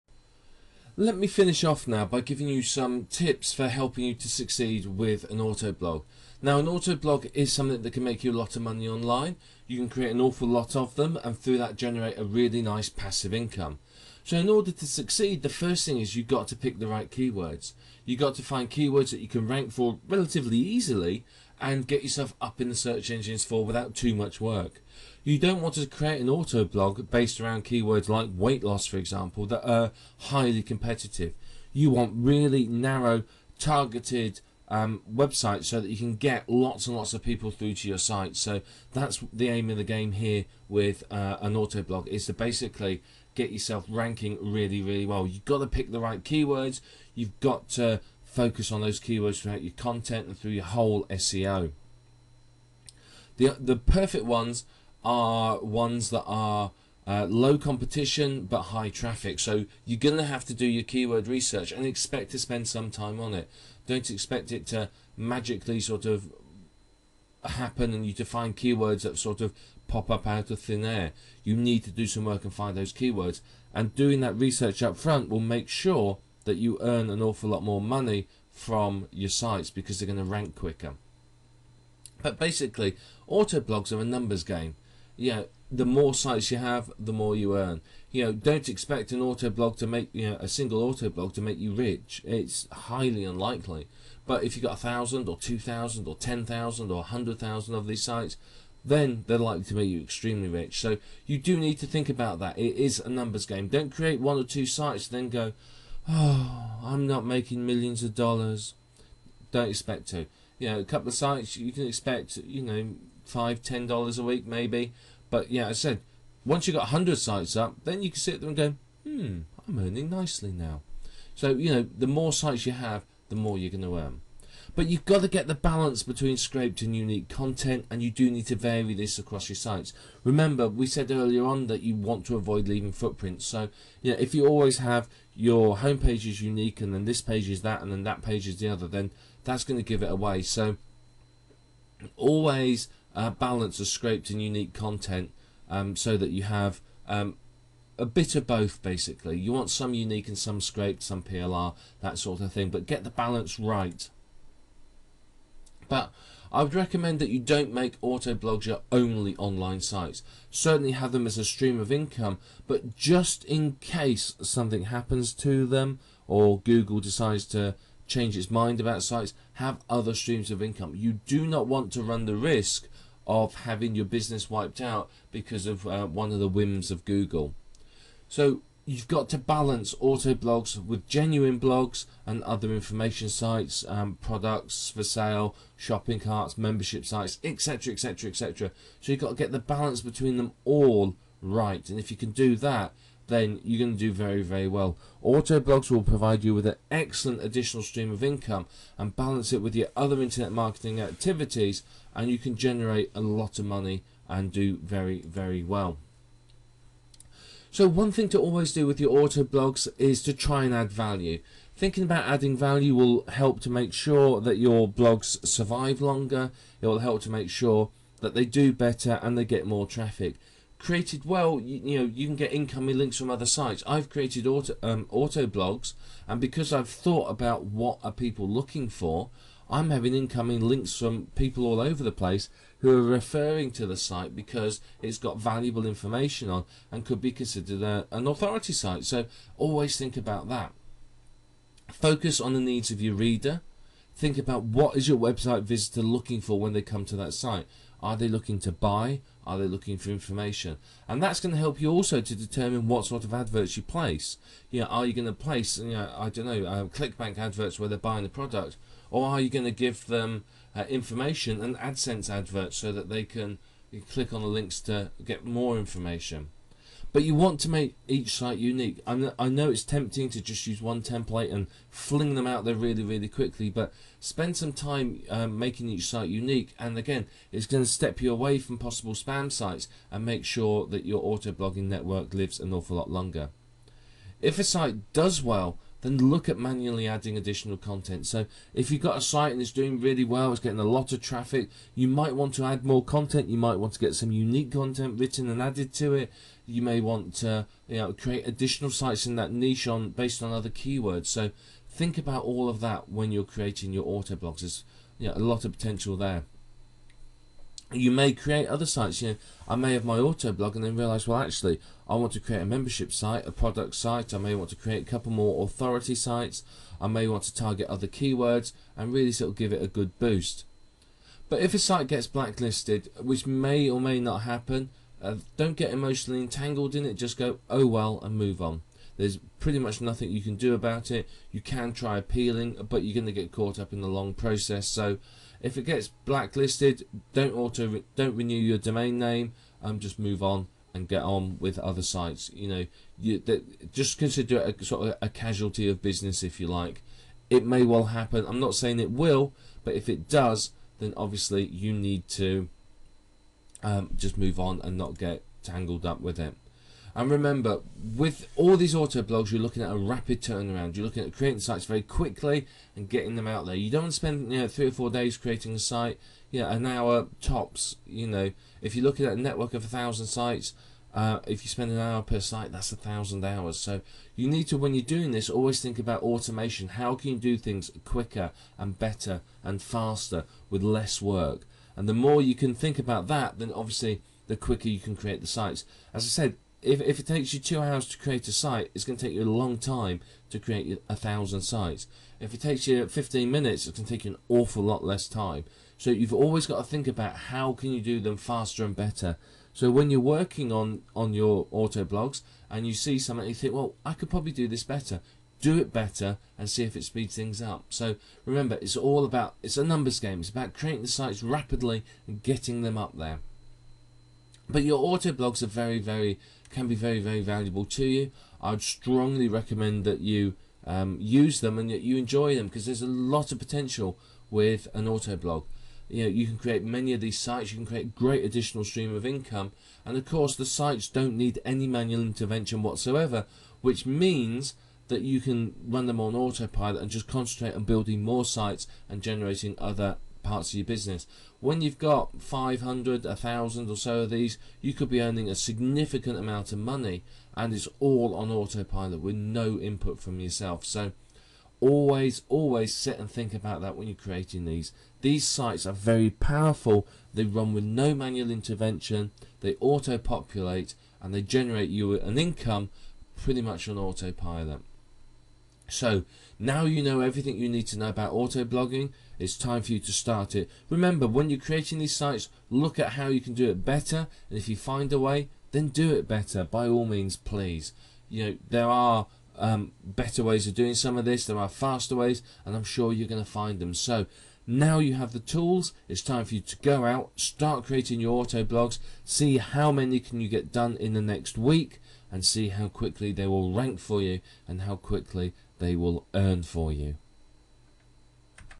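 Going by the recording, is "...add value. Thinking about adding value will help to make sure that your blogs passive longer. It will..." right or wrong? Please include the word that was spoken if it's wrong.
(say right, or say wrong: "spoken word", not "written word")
wrong: "survive", not "passive".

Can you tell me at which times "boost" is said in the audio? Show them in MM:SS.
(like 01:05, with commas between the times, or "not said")
05:20.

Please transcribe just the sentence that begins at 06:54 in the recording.
But your auto blogs are very, very can be very, very valuable to you.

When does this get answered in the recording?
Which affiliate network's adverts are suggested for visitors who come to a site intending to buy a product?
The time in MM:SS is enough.
04:16.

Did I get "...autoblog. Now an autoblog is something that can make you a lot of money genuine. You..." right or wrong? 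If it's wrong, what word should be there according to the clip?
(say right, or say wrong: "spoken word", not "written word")
wrong: "online", not "genuine".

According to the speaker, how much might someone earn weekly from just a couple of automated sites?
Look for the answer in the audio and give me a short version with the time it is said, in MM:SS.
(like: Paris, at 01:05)
5 to 10 dollars, at 01:53.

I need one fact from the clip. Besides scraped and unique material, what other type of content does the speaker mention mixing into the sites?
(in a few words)
PLR.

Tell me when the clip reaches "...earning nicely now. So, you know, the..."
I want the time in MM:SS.
01:59.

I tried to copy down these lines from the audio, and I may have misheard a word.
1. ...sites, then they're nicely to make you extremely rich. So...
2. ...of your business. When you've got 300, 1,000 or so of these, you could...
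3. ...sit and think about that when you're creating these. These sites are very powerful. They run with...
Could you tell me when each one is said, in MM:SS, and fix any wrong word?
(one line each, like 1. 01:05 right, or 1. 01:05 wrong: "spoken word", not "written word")
1. 01:38 wrong: "likely", not "nicely"
2. 07:20 wrong: "500", not "300"
3. 07:32 right.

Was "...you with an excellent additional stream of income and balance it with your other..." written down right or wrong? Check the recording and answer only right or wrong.
right.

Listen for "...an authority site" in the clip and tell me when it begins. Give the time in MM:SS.
03:58.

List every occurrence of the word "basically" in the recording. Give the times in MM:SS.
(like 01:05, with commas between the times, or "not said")
00:42, 01:22, 02:28.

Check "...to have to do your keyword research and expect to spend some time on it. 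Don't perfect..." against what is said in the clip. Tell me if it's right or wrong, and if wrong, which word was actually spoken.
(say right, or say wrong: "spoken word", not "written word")
wrong: "expect", not "perfect".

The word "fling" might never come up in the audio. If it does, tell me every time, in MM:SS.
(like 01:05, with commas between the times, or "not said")
04:31.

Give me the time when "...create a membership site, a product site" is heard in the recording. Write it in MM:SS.
05:12.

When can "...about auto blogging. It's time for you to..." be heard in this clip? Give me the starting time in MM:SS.
07:48.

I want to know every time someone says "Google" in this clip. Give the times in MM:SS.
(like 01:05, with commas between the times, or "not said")
02:46, 02:57.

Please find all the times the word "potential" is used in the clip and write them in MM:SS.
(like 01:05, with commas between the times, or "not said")
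05:05, 07:03.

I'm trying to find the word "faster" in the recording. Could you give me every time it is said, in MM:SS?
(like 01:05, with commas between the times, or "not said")
06:19, 06:38, 08:01.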